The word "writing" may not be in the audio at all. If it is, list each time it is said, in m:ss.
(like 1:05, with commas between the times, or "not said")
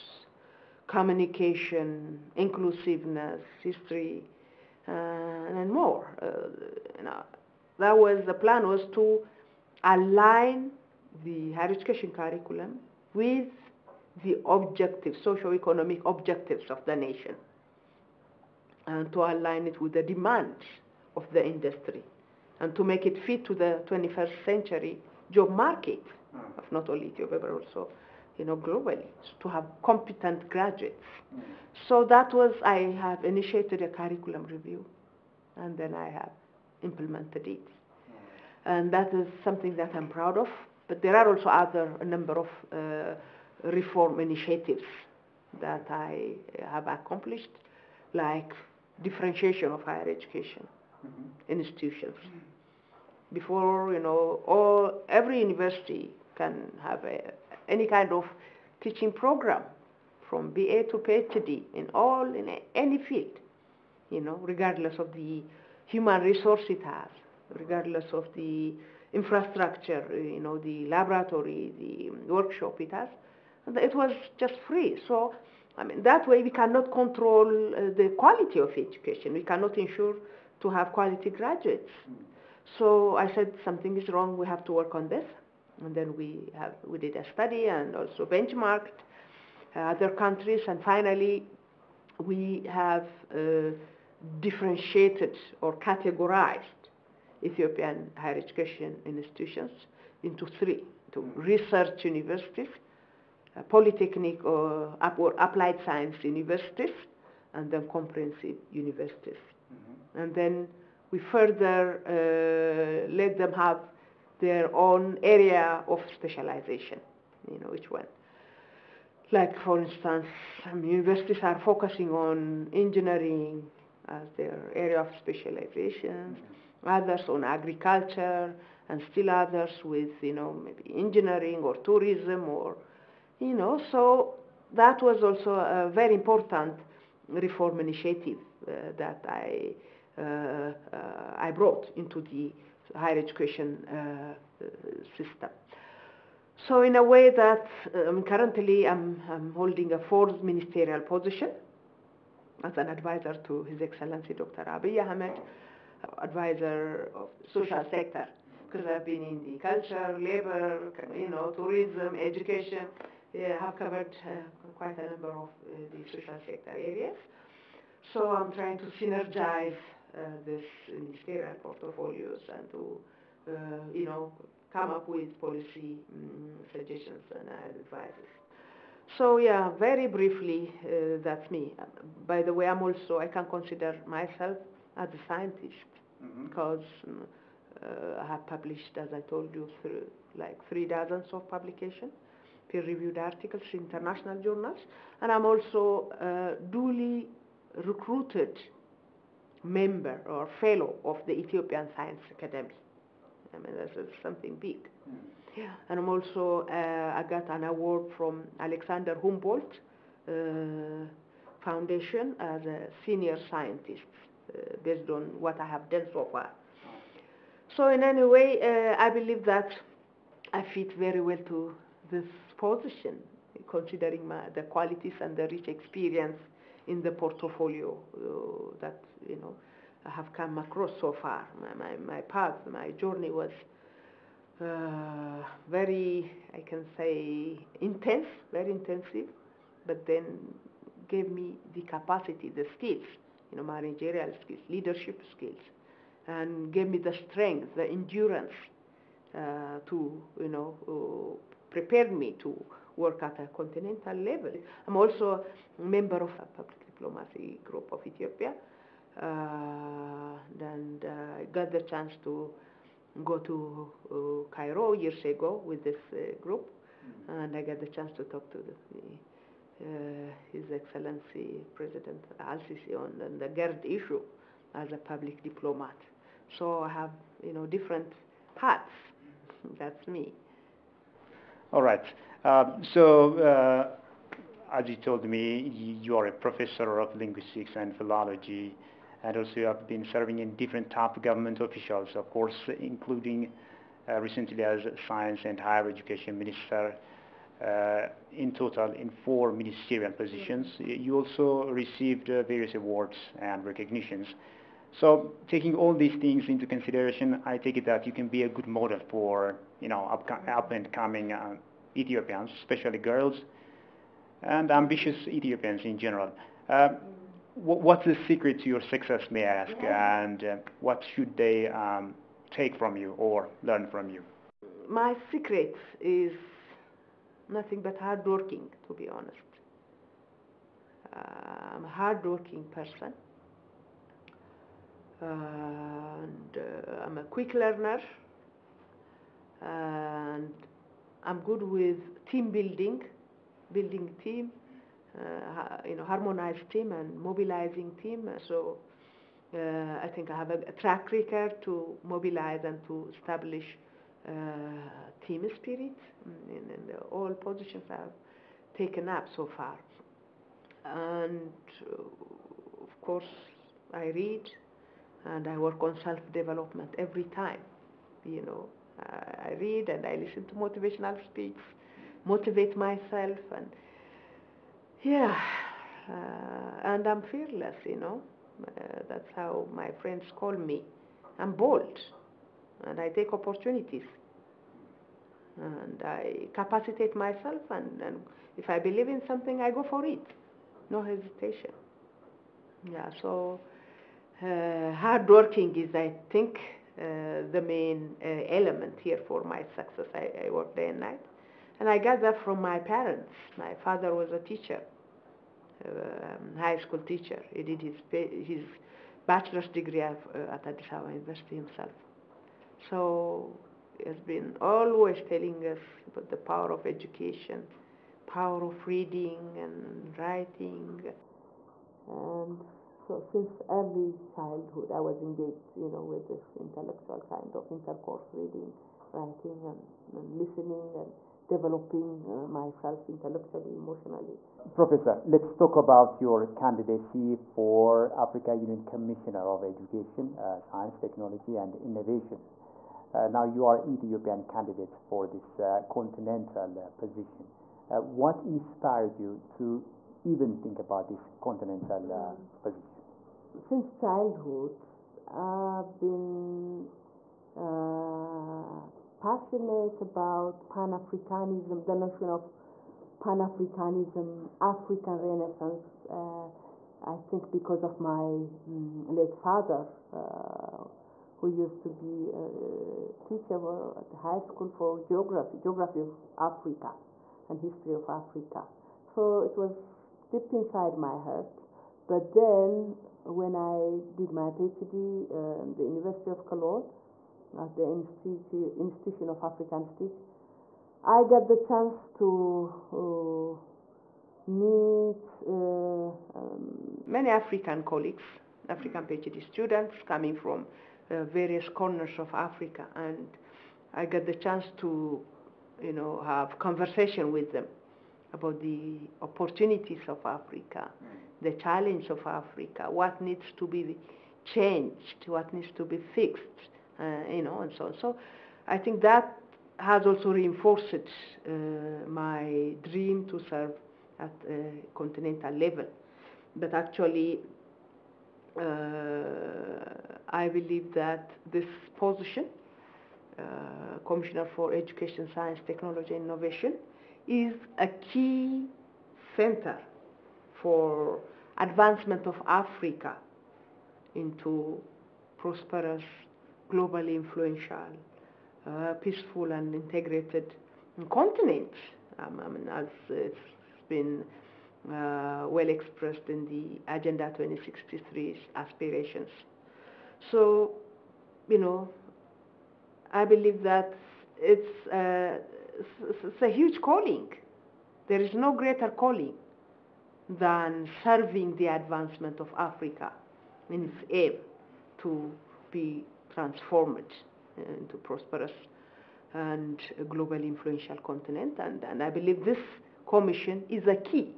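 7:00, 7:09.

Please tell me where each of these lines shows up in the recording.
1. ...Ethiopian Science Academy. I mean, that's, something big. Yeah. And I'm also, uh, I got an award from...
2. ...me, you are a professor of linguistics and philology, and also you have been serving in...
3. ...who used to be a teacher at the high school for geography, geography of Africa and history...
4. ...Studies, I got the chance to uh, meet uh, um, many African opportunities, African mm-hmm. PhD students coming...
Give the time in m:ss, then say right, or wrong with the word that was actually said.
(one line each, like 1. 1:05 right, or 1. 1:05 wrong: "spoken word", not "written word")
1. 3:21 right
2. 4:45 right
3. 7:51 right
4. 8:09 wrong: "colleagues", not "opportunities".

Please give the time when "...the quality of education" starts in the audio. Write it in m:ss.
1:17.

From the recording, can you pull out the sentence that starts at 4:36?
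So I have, you know, different hats.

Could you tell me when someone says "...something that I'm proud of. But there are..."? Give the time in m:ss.
0:39.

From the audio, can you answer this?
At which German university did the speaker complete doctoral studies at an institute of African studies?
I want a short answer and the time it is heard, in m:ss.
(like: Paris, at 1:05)
University of Cologne, at 8:05.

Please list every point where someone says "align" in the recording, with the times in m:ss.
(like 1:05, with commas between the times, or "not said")
0:09, 0:19.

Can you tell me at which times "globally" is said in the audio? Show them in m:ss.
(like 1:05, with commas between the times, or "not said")
0:28, 9:06, 9:40.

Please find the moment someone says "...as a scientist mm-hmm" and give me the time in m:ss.
3:04.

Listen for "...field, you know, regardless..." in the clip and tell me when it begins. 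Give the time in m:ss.
1:02.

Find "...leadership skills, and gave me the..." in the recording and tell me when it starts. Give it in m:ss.
4:04.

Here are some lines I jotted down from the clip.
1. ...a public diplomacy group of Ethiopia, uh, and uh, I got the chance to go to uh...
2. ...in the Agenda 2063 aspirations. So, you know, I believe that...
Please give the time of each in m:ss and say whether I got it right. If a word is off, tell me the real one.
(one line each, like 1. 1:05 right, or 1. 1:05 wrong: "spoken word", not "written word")
1. 4:16 right
2. 9:16 right.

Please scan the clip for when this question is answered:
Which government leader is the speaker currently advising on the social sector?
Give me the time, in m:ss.
2:34.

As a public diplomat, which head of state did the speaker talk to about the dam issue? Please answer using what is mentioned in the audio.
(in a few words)
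Al-Sisi.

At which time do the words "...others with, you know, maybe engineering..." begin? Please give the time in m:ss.
2:09.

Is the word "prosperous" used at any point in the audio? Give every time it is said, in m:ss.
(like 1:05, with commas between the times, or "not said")
9:05, 9:37.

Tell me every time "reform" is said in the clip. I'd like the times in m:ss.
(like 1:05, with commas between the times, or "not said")
0:43, 2:17.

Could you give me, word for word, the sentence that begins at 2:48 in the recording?
So I'm trying to synergize uh, this ministerial portfolios and to, uh, you know, come up with policy um, suggestions and advices.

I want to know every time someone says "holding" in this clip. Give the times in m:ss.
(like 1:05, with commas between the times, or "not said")
2:29.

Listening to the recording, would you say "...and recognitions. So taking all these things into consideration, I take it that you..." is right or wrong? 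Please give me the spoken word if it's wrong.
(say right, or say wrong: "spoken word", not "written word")
right.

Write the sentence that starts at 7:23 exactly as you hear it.
Uh, now you are Ethiopian candidate for this uh, continental uh, position.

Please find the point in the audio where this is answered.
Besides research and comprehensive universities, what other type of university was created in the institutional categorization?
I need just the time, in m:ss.
1:43.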